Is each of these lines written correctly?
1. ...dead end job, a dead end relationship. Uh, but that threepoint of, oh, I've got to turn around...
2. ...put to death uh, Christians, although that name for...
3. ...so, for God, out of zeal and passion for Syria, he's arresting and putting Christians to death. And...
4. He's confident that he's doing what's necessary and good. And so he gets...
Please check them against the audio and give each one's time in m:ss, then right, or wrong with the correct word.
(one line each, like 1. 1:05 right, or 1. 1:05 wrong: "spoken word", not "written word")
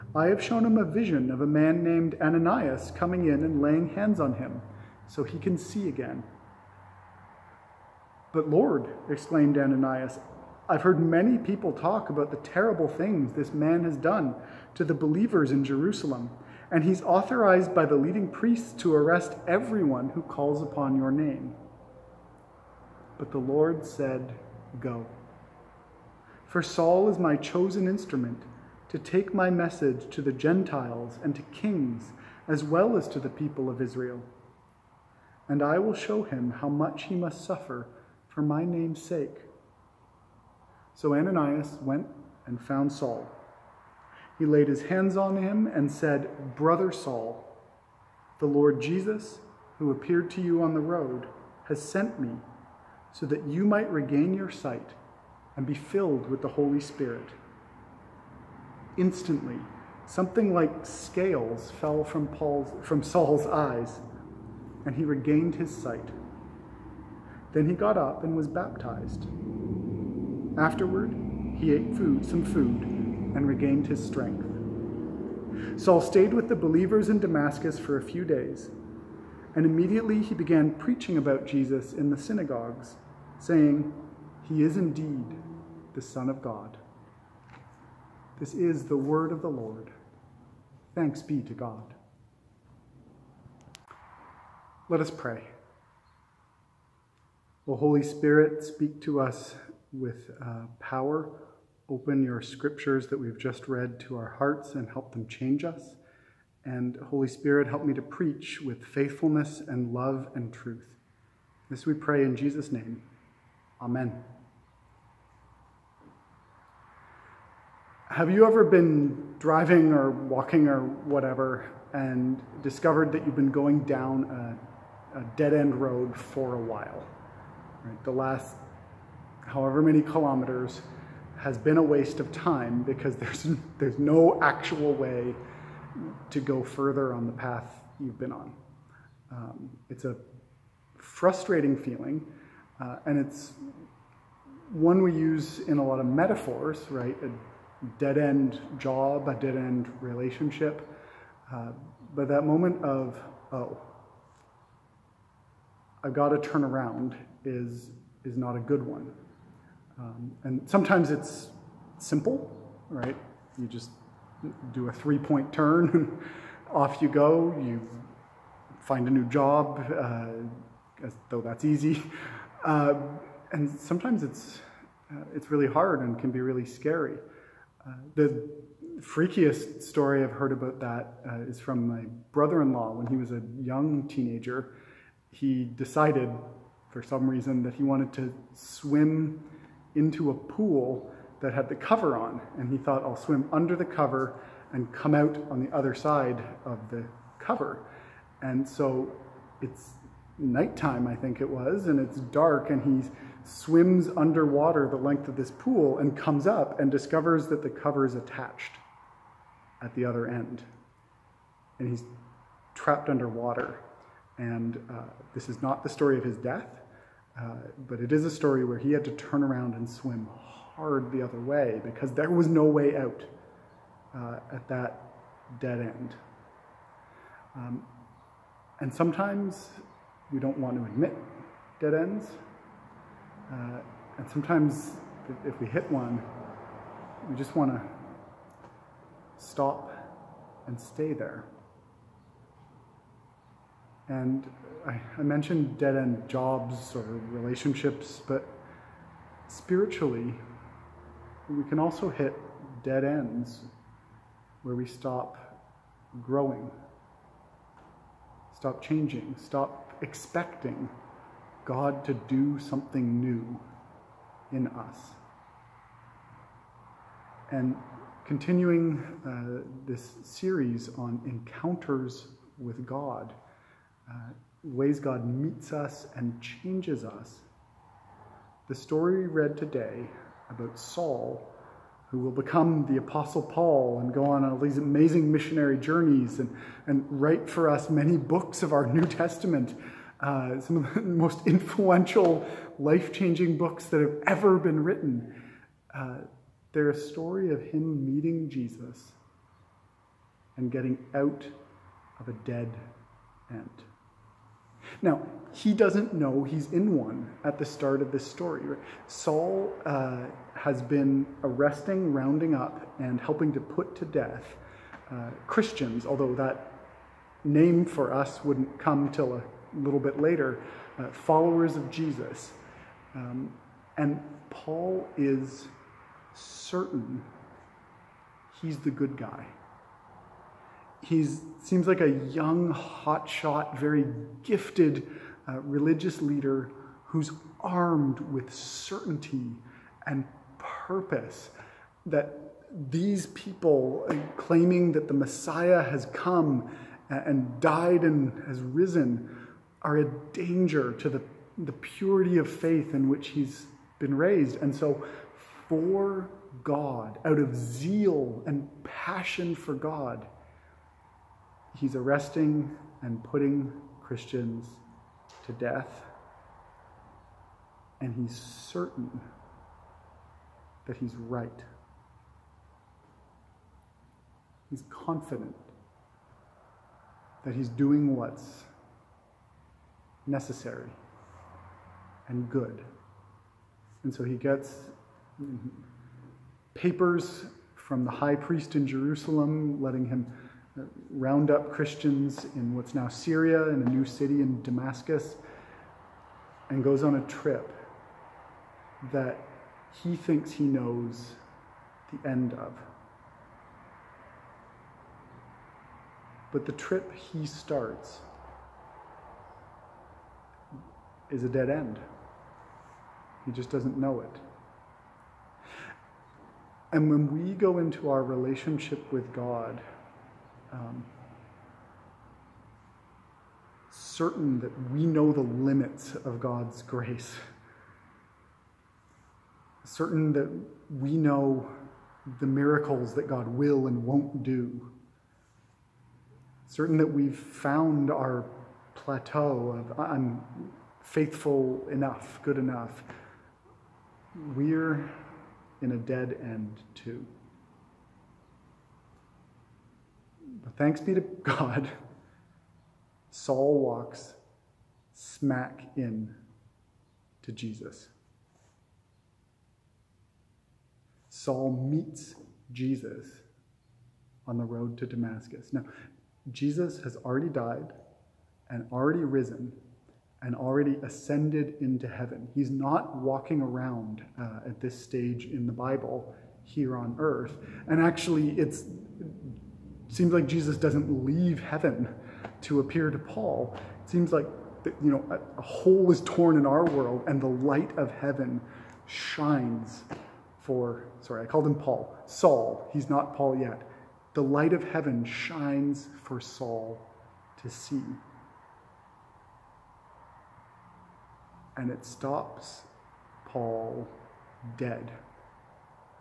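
1. 2:27 wrong: "moment", not "threepoint"
2. 5:13 right
3. 5:54 wrong: "God", not "Syria"
4. 6:14 right.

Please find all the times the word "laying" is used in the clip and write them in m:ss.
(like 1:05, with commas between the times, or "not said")
0:03.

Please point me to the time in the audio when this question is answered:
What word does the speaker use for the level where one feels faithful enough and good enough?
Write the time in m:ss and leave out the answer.
7:18.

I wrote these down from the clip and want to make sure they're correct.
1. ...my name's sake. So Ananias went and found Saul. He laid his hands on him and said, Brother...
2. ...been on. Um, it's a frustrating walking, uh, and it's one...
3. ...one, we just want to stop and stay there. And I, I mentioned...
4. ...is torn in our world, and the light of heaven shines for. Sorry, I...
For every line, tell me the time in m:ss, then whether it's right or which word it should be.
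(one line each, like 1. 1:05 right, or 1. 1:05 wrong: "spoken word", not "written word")
1. 0:38 right
2. 2:18 wrong: "feeling", not "walking"
3. 3:55 right
4. 8:06 right.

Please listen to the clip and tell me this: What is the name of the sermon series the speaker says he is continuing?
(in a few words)
encounters with God.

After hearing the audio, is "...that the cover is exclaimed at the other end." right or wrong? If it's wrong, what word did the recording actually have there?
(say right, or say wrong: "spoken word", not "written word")
wrong: "attached", not "exclaimed".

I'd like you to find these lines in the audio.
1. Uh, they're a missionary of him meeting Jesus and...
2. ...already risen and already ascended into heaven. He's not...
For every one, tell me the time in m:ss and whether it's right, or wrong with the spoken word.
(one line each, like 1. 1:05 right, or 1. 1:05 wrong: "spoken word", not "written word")
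1. 4:55 wrong: "story", not "missionary"
2. 7:48 right.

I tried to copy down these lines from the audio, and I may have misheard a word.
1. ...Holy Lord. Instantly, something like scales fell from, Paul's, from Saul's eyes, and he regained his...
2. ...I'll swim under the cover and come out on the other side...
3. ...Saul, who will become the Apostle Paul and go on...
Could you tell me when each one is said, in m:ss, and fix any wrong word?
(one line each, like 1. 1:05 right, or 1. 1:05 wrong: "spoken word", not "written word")
1. 0:56 wrong: "Spirit", not "Lord"
2. 3:13 right
3. 4:40 right.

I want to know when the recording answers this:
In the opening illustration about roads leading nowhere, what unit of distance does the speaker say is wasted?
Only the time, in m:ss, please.
2:10.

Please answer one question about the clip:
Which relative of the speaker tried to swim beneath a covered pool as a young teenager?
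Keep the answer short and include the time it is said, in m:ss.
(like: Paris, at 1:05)
brother-in-law, at 3:02.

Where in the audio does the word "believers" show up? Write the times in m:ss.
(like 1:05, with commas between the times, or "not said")
0:14, 1:16.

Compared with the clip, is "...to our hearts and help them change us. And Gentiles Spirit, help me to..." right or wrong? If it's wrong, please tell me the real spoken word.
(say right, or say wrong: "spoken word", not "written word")
wrong: "Holy", not "Gentiles".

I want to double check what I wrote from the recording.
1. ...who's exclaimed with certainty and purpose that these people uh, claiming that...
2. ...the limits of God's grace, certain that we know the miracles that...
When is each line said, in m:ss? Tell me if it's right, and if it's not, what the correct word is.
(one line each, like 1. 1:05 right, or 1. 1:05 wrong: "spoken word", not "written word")
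1. 5:37 wrong: "armed", not "exclaimed"
2. 7:05 right.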